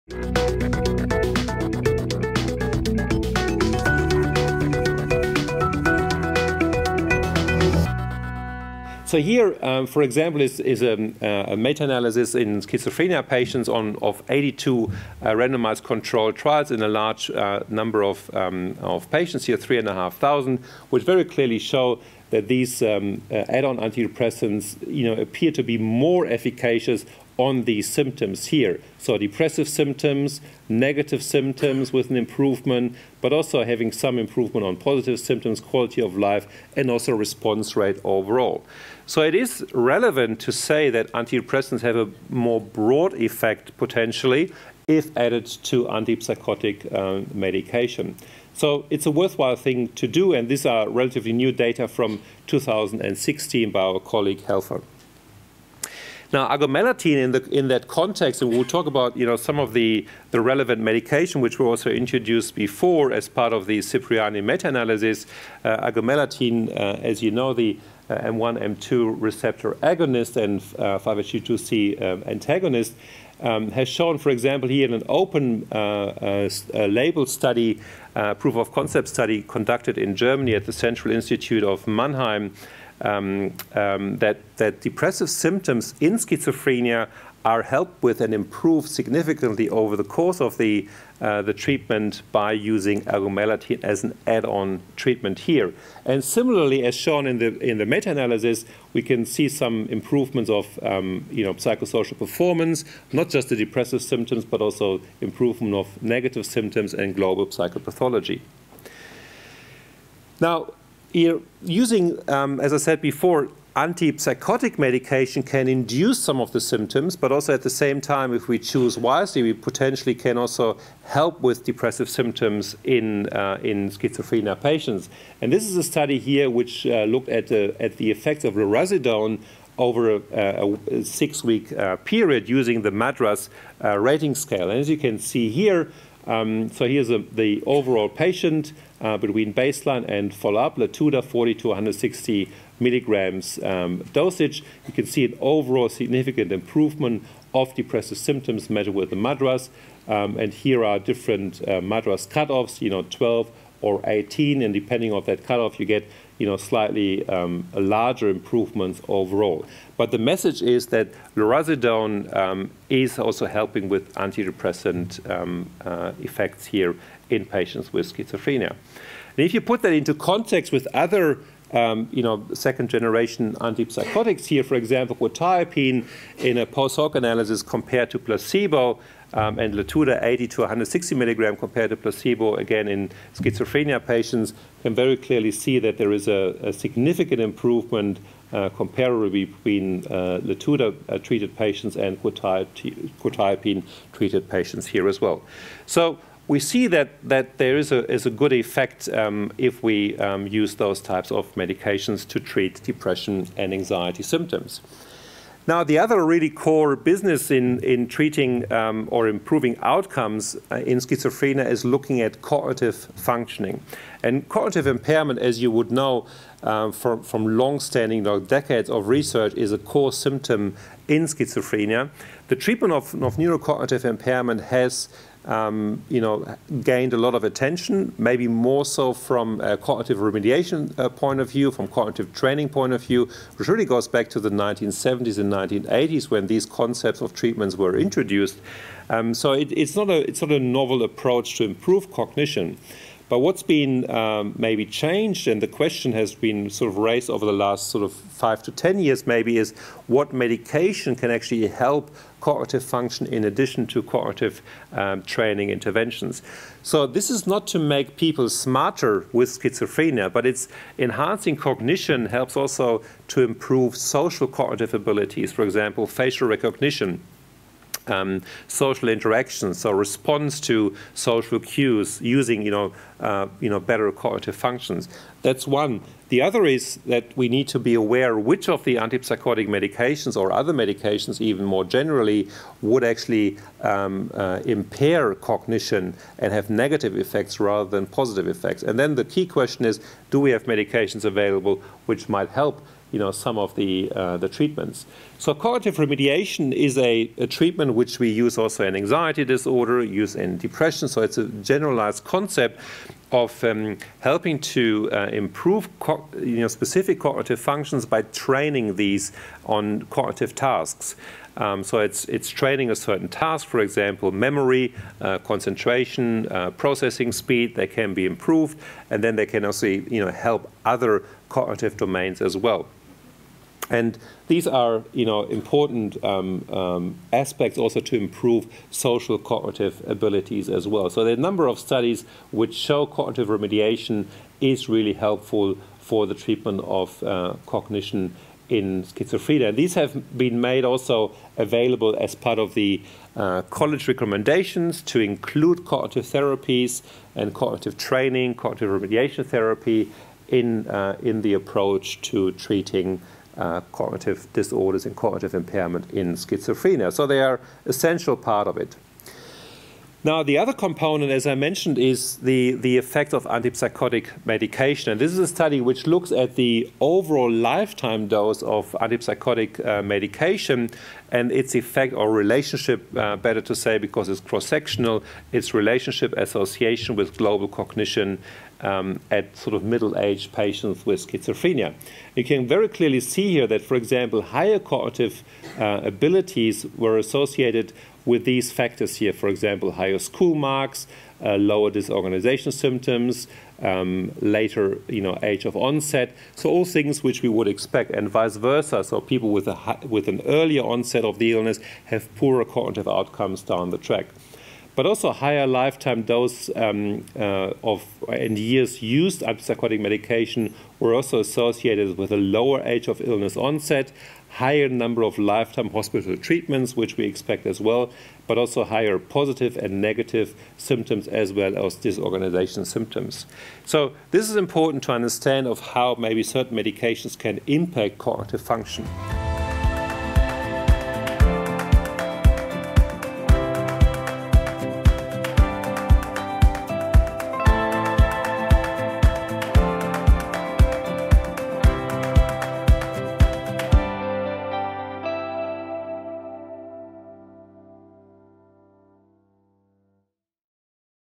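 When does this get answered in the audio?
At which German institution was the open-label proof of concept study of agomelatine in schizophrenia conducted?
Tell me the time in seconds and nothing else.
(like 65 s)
80 s.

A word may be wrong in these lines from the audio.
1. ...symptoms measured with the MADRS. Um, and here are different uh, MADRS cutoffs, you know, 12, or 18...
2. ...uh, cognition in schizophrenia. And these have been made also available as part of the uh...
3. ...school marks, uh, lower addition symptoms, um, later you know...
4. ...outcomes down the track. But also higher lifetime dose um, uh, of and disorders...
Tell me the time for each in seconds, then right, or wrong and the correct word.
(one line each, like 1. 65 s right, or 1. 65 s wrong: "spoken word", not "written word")
1. 148 s right
2. 337 s right
3. 390 s wrong: "disorganization", not "addition"
4. 403 s wrong: "years", not "disorders".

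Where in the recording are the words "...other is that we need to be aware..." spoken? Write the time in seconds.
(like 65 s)
276 s.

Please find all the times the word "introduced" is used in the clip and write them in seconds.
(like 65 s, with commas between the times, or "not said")
61 s, 237 s.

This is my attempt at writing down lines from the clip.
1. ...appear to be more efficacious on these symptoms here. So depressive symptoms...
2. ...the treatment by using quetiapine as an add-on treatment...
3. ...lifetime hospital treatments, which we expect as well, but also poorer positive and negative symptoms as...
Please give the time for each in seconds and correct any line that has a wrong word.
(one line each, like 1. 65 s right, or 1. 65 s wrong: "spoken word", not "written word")
1. 25 s right
2. 91 s wrong: "agomelatine", not "quetiapine"
3. 415 s wrong: "higher", not "poorer".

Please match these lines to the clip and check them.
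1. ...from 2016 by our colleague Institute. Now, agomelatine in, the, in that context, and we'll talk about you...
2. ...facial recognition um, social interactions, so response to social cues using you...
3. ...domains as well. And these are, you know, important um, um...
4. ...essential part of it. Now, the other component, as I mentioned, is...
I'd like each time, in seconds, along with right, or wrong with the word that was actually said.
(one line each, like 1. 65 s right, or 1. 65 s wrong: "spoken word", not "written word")
1. 51 s wrong: "Helfer", not "Institute"
2. 266 s right
3. 321 s right
4. 357 s right.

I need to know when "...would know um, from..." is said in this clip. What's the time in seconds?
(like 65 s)
215 s.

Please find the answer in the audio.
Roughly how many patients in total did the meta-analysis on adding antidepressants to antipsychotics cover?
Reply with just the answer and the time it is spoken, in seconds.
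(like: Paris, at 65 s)
3,500, at 19 s.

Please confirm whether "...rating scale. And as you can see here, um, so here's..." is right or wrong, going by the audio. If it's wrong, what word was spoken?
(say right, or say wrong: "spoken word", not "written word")
right.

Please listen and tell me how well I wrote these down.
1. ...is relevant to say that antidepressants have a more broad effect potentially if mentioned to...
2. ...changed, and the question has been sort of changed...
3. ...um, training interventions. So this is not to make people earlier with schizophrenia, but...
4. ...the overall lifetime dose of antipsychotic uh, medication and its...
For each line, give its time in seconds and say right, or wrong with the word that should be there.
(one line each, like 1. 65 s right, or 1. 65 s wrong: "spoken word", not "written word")
1. 39 s wrong: "added", not "mentioned"
2. 244 s wrong: "raised", not "changed"
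3. 254 s wrong: "smarter", not "earlier"
4. 366 s right.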